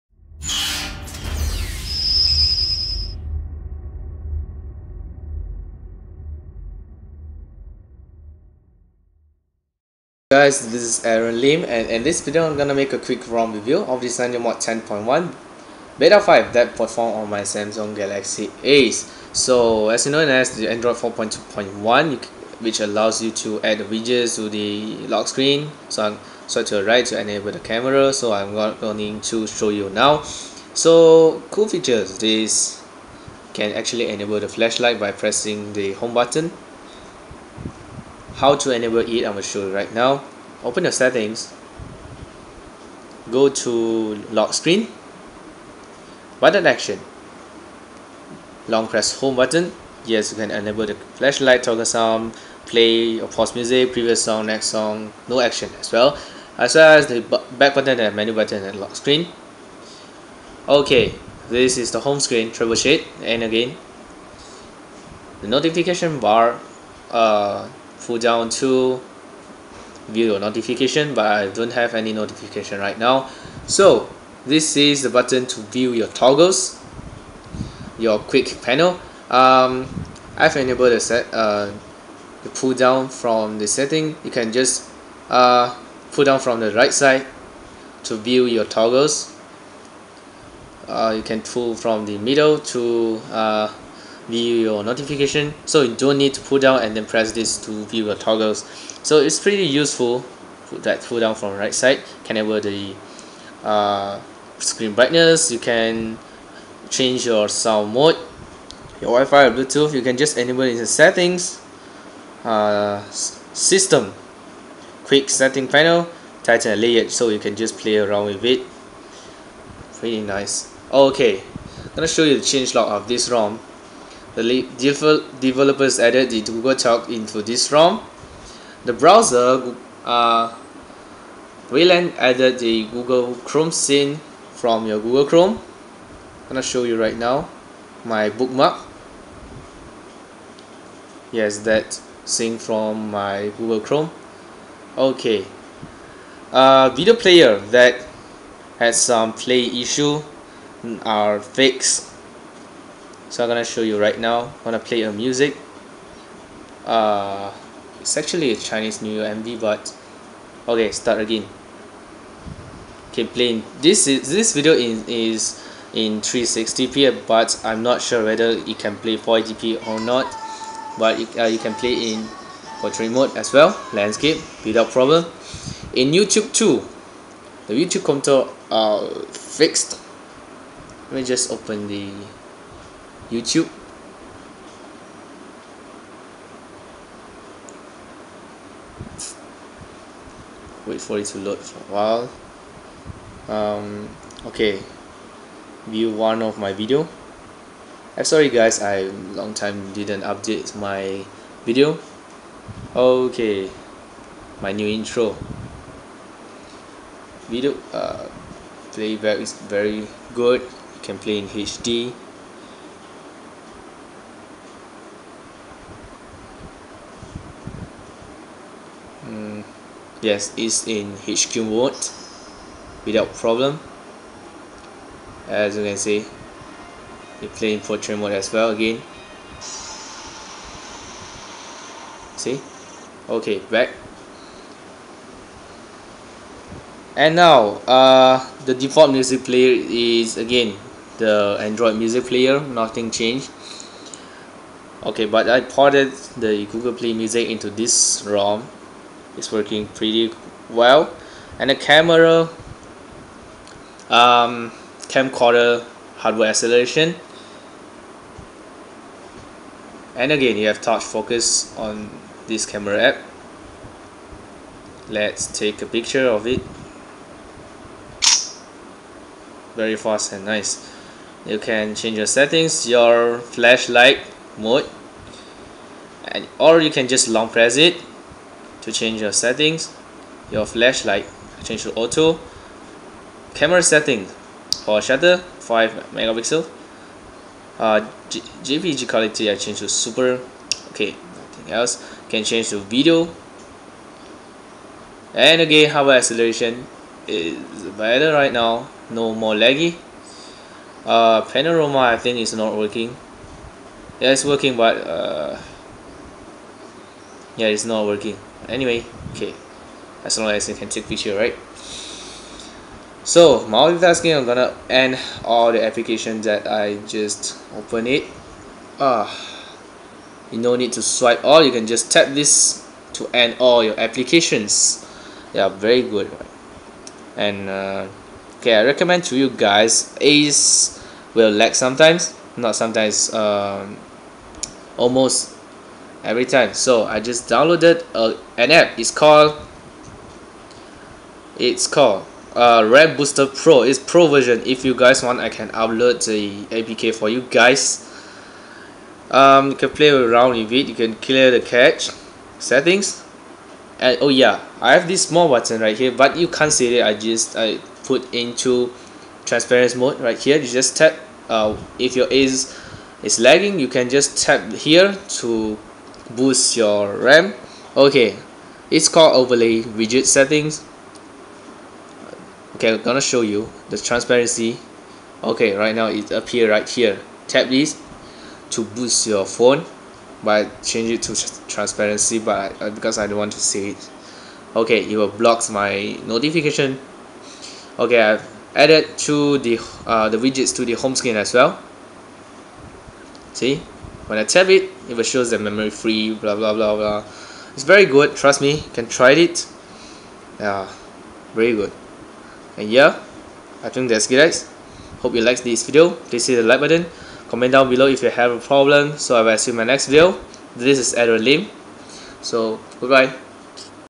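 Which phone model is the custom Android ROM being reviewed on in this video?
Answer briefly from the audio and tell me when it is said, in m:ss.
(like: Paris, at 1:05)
Samsung Galaxy Ace, at 0:17.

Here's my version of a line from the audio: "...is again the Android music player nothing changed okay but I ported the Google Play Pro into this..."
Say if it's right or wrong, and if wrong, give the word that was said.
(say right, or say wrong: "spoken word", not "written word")
wrong: "Music", not "Pro".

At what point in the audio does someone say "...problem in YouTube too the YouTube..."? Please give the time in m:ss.
2:54.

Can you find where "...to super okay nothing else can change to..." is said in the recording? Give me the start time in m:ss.
4:49.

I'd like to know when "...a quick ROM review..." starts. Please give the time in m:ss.
0:12.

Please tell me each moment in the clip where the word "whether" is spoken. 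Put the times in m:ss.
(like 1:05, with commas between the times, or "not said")
2:48.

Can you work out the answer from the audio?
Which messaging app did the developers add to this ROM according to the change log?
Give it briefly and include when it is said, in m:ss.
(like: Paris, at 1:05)
Google Talk, at 2:06.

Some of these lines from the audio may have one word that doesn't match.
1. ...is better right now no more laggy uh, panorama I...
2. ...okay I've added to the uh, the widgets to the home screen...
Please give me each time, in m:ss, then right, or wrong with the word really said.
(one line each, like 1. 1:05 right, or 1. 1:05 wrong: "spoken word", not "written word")
1. 4:57 right
2. 6:27 right.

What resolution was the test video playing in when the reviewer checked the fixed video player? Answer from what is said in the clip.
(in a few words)
360p.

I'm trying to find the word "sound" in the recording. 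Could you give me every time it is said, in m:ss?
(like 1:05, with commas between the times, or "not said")
0:51, 1:47.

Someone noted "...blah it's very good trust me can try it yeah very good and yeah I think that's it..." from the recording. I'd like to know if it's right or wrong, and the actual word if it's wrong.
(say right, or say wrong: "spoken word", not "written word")
right.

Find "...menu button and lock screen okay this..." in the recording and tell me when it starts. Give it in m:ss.
0:58.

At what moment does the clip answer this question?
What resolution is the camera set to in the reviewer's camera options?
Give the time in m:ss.
4:45.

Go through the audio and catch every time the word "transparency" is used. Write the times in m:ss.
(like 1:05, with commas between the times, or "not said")
5:59, 6:13, 6:21.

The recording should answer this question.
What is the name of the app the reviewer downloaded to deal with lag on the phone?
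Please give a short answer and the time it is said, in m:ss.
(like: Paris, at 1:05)
Red Booster Pro, at 5:42.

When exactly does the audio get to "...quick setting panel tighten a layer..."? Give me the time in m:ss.
1:55.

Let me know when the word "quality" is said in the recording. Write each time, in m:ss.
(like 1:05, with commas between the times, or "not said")
4:49.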